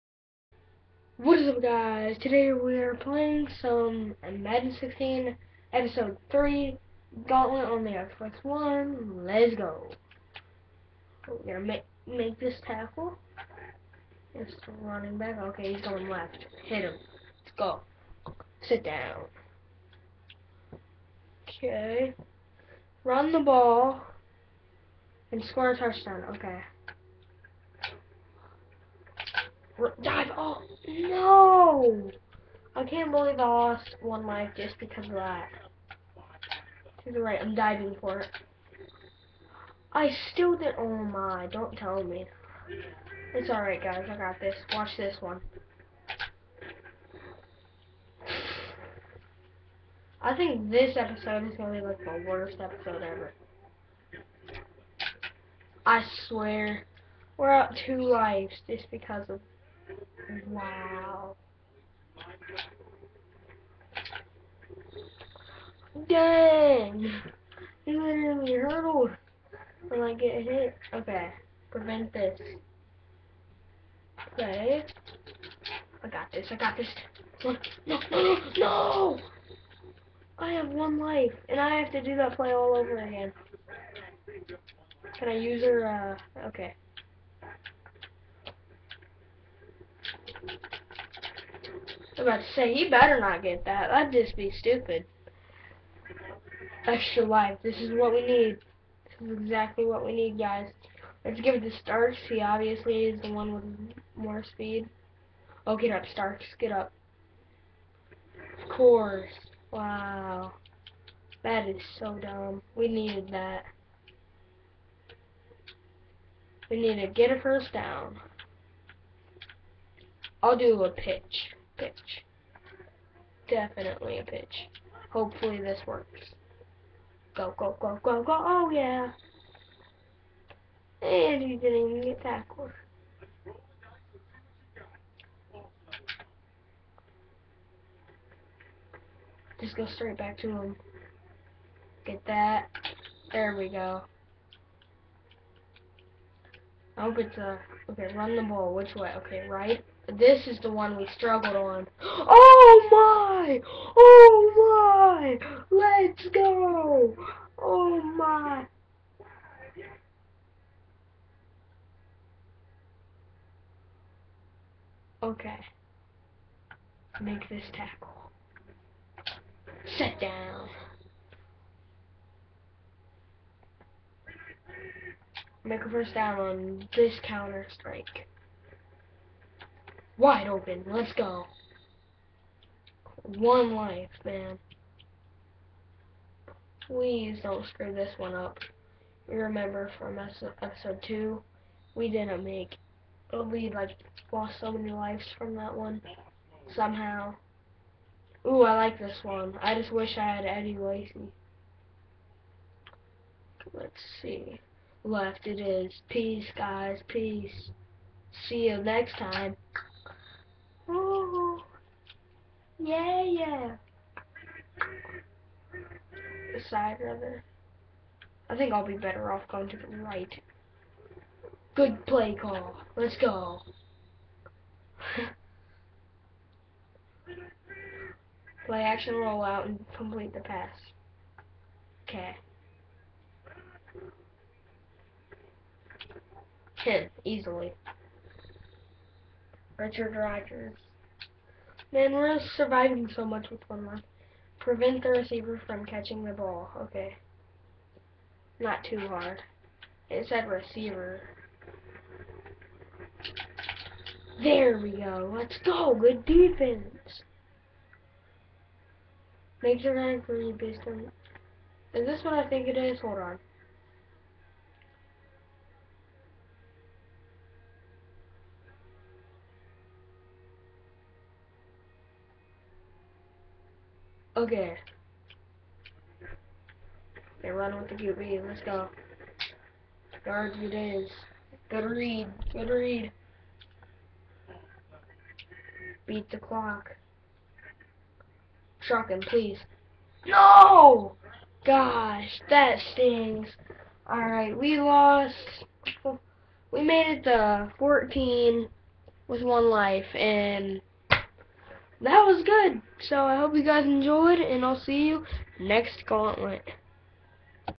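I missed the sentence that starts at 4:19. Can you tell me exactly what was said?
Make sure I agree based on...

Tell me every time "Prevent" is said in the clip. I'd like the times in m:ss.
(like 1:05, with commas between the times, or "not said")
1:11, 4:04.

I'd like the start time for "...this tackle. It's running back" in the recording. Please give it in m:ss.
0:12.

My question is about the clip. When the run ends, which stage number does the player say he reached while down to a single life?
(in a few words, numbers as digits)
14.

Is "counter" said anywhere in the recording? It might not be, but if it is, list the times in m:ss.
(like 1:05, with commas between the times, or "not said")
2:57.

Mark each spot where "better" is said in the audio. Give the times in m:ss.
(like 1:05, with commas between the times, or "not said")
1:32, 3:38.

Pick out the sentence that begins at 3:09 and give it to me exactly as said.
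You remember from episode 2, we didn't make...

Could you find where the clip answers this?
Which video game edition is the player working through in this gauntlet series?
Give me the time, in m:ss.
0:04.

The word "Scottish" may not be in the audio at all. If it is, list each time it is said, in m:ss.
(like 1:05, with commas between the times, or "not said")
not said.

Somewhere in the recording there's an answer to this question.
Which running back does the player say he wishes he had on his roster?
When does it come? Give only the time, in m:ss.
3:20.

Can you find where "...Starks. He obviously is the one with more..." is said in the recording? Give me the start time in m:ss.
1:41.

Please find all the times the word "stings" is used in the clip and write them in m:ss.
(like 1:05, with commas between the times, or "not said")
4:52.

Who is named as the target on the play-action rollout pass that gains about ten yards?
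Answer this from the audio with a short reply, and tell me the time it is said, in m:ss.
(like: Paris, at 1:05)
Richard Rodgers, at 3:59.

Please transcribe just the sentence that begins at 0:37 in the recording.
You're right, I'm diving for it.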